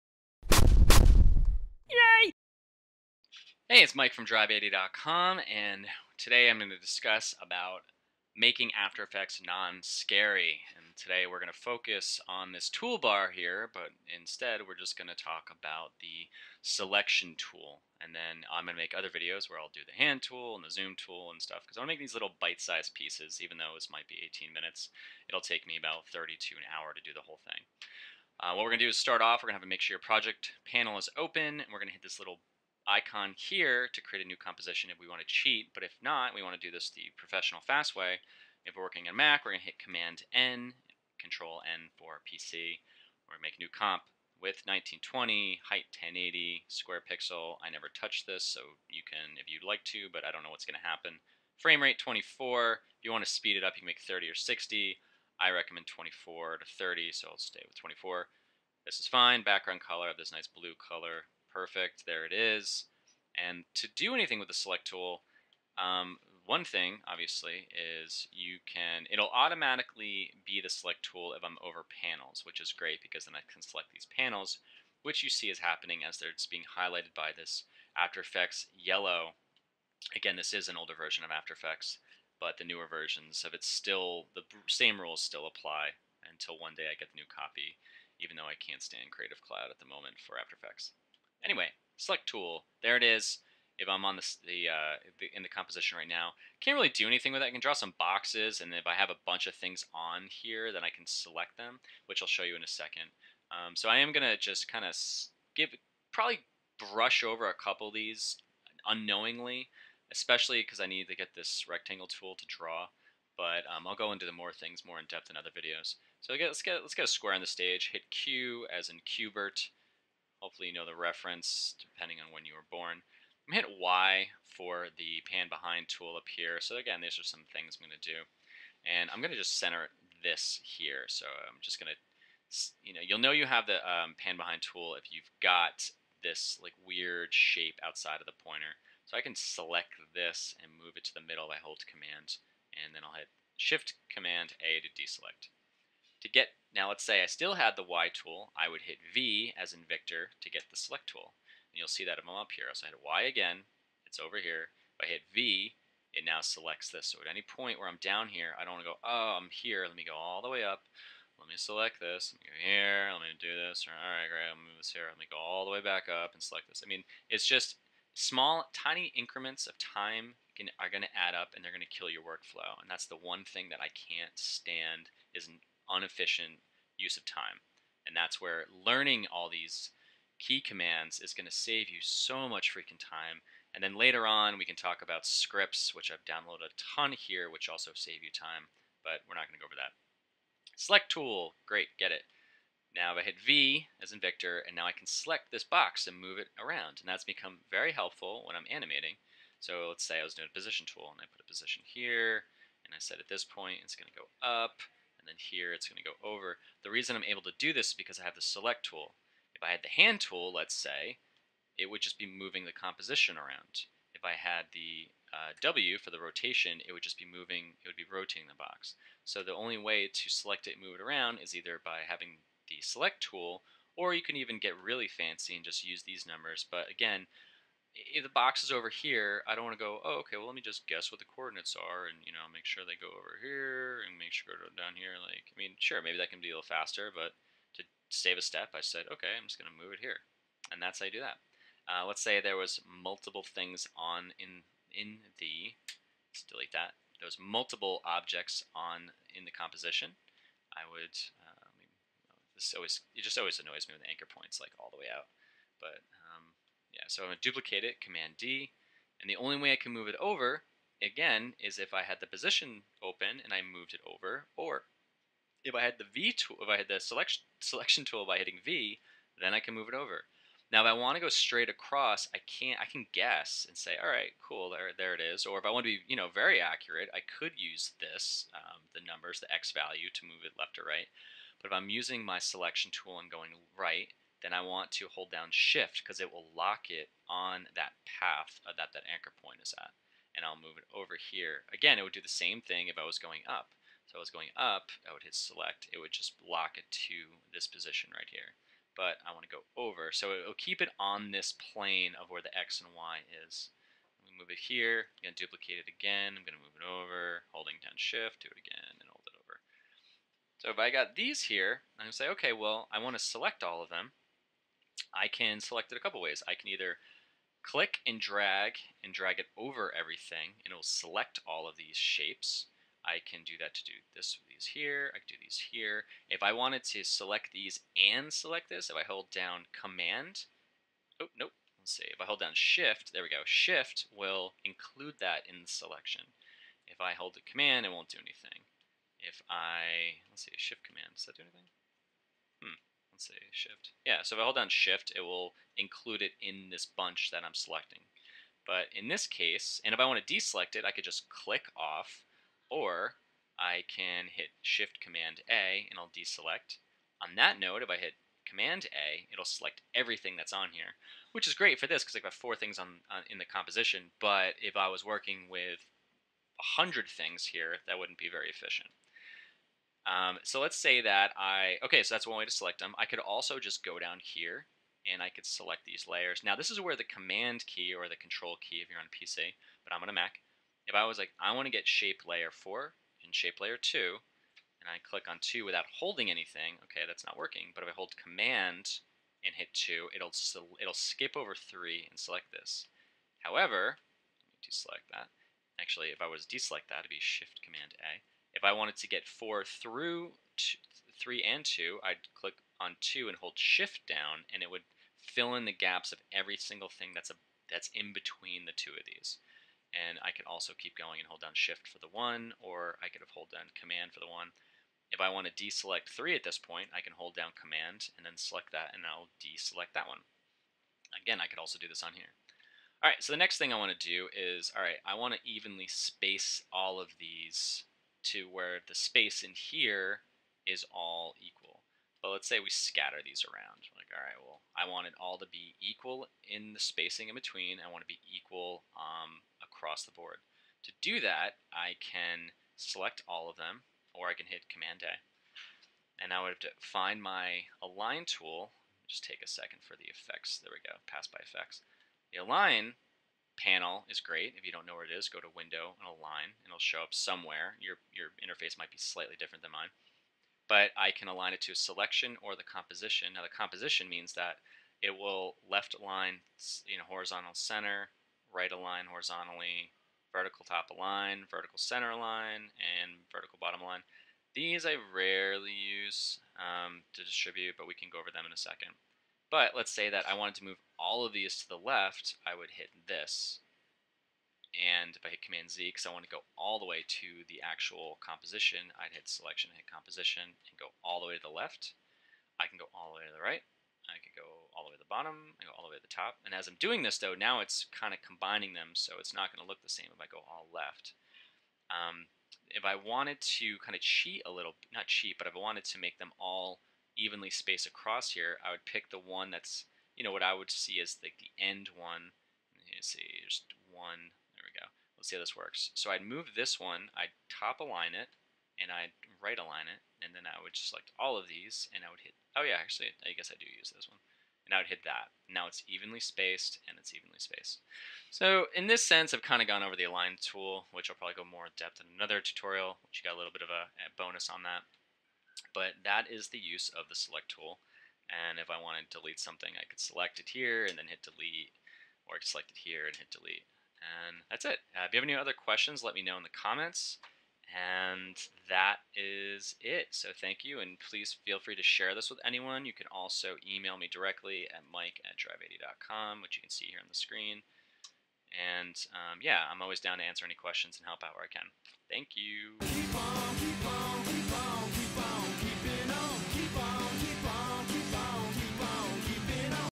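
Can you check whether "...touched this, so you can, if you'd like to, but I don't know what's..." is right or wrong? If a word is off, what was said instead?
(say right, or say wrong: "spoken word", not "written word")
right.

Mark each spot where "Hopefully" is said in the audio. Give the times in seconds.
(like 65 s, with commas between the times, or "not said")
120 s.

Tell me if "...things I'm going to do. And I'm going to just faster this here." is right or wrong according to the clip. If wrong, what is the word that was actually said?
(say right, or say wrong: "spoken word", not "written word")
wrong: "center", not "faster".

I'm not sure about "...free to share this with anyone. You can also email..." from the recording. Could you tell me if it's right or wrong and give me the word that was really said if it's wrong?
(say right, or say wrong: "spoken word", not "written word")
right.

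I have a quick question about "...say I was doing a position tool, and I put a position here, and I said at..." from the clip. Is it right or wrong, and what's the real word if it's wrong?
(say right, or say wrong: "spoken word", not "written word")
right.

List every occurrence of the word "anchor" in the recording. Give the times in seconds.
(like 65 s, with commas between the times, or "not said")
254 s, 289 s.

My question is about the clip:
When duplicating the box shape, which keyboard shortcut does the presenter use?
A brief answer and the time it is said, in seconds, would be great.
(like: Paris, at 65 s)
Command-D, at 258 s.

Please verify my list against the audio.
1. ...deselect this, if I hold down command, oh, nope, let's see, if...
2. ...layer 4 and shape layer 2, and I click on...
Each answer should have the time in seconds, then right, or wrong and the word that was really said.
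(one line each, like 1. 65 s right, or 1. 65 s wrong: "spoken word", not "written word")
1. 328 s wrong: "select", not "deselect"
2. 382 s right.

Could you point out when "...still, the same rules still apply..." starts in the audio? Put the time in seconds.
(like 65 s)
83 s.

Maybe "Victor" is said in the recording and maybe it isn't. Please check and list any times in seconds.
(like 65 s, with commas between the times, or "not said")
149 s, 194 s.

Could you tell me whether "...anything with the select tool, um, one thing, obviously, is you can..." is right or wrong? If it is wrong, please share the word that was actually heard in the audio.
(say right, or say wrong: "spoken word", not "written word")
right.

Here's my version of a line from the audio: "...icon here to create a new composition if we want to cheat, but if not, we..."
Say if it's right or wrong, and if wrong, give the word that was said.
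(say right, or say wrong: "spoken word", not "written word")
right.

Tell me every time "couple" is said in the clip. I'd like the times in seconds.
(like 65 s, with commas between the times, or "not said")
107 s, 316 s.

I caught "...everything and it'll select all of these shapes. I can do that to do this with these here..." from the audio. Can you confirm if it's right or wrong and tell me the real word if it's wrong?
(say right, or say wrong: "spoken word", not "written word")
right.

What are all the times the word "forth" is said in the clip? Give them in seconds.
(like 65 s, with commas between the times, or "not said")
not said.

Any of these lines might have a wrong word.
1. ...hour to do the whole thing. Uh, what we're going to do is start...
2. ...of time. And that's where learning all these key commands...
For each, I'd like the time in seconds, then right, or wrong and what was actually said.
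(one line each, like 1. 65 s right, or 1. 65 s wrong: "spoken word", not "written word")
1. 26 s right
2. 177 s right.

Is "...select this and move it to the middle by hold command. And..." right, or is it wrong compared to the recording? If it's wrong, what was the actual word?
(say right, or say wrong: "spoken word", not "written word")
right.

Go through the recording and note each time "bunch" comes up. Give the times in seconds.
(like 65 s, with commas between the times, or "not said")
99 s, 346 s.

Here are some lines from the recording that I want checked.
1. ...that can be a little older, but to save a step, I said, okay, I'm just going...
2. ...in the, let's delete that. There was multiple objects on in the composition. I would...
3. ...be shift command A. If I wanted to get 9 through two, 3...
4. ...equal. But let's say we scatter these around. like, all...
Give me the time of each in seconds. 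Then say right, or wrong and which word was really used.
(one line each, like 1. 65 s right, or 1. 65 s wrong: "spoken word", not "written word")
1. 236 s wrong: "faster", not "older"
2. 244 s right
3. 397 s wrong: "4", not "9"
4. 431 s right.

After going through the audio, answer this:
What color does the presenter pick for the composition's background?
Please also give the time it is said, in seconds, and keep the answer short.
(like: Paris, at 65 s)
Blue, at 60 s.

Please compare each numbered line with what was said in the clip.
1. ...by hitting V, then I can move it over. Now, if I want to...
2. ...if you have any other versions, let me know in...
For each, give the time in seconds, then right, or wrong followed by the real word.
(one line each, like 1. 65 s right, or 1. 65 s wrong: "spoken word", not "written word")
1. 268 s right
2. 545 s wrong: "questions", not "versions".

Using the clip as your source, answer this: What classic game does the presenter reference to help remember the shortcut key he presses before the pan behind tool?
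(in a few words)
Qbert.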